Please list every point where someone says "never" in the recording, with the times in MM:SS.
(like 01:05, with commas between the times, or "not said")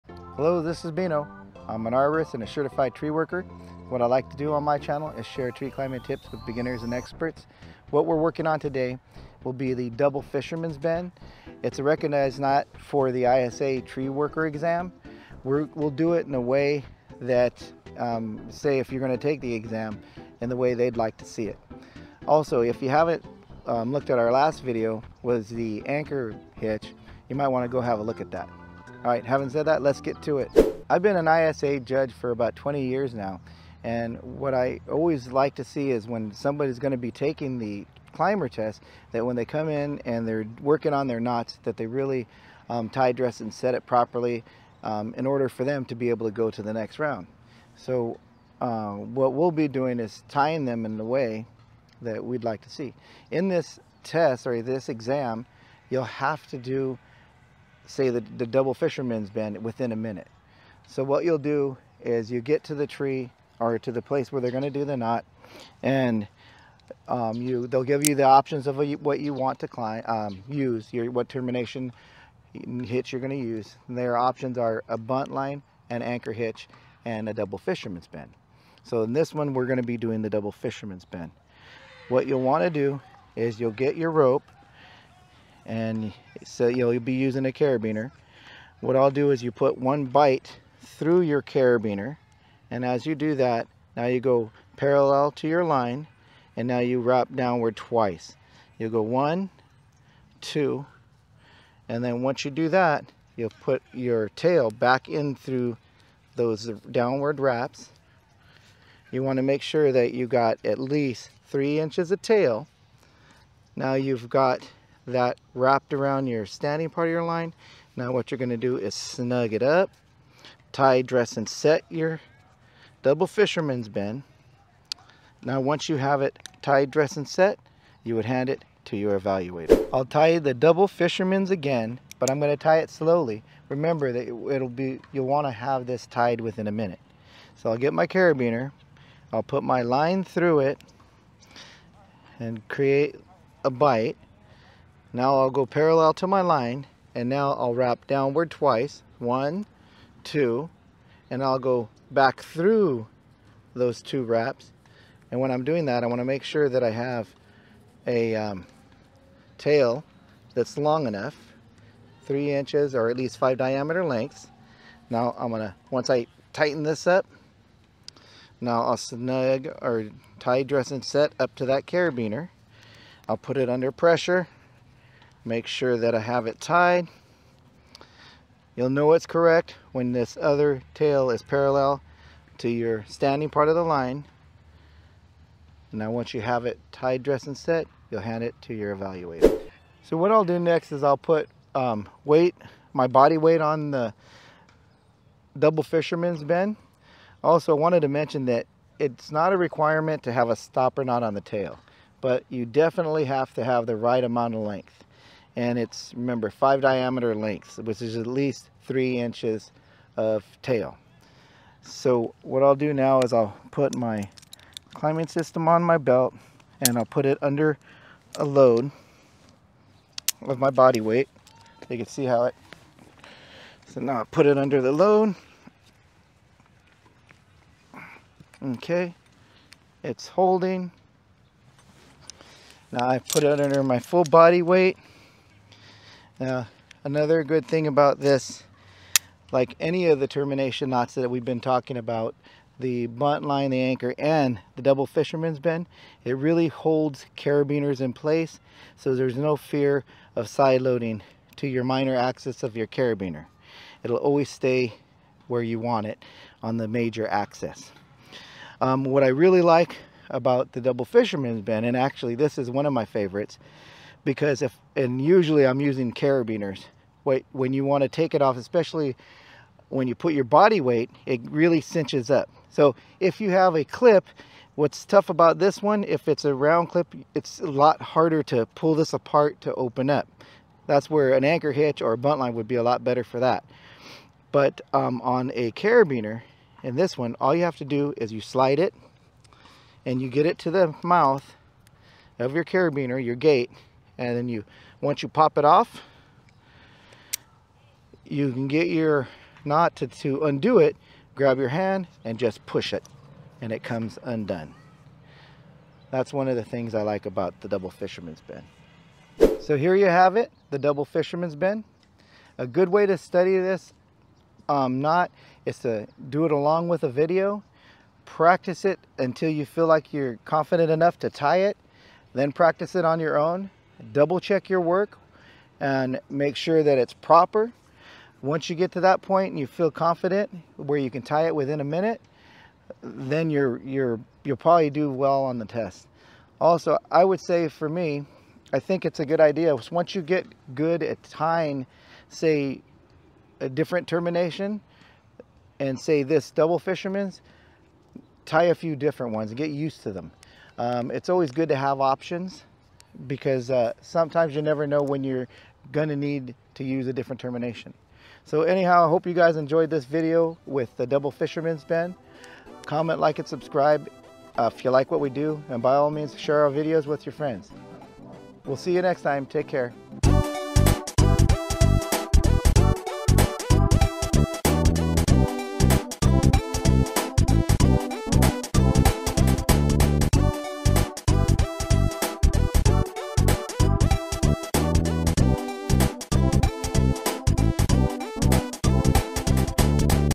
05:54.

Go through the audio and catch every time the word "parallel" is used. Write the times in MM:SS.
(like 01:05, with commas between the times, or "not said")
01:34, 02:25, 03:01.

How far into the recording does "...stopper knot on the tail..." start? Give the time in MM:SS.
03:20.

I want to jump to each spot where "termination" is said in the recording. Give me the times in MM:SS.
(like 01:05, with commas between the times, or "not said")
01:11, 04:00, 05:44, 05:57.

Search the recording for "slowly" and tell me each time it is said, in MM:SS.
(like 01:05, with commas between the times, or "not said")
02:12.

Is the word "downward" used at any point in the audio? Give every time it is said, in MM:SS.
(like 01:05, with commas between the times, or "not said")
01:37, 01:46, 02:28.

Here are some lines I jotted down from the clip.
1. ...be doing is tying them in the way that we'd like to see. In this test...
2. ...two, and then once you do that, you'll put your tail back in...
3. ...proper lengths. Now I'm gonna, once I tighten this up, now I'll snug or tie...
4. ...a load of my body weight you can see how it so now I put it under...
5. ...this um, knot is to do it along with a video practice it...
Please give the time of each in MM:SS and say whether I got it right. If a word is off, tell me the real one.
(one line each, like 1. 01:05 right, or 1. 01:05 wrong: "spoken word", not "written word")
1. 00:49 right
2. 01:40 right
3. 02:43 wrong: "diameter", not "proper"
4. 03:38 right
5. 05:13 right.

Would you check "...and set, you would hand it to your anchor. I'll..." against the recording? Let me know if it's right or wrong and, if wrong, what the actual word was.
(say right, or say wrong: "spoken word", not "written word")
wrong: "evaluator", not "anchor".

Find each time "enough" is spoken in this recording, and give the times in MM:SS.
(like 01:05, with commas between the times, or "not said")
02:41, 05:20.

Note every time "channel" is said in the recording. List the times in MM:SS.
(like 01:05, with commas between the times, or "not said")
00:04.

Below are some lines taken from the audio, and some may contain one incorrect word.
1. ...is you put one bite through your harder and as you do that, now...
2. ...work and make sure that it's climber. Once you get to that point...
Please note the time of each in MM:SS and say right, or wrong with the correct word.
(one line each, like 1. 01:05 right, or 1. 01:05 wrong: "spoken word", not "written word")
1. 01:29 wrong: "carabiner", not "harder"
2. 05:24 wrong: "proper", not "climber".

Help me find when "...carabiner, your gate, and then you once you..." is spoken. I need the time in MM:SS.
04:52.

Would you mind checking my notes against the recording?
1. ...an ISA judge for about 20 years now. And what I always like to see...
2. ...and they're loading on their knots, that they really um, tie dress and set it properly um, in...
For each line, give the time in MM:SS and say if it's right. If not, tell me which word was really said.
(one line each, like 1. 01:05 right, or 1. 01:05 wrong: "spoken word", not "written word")
1. 00:31 right
2. 00:40 wrong: "working", not "loading".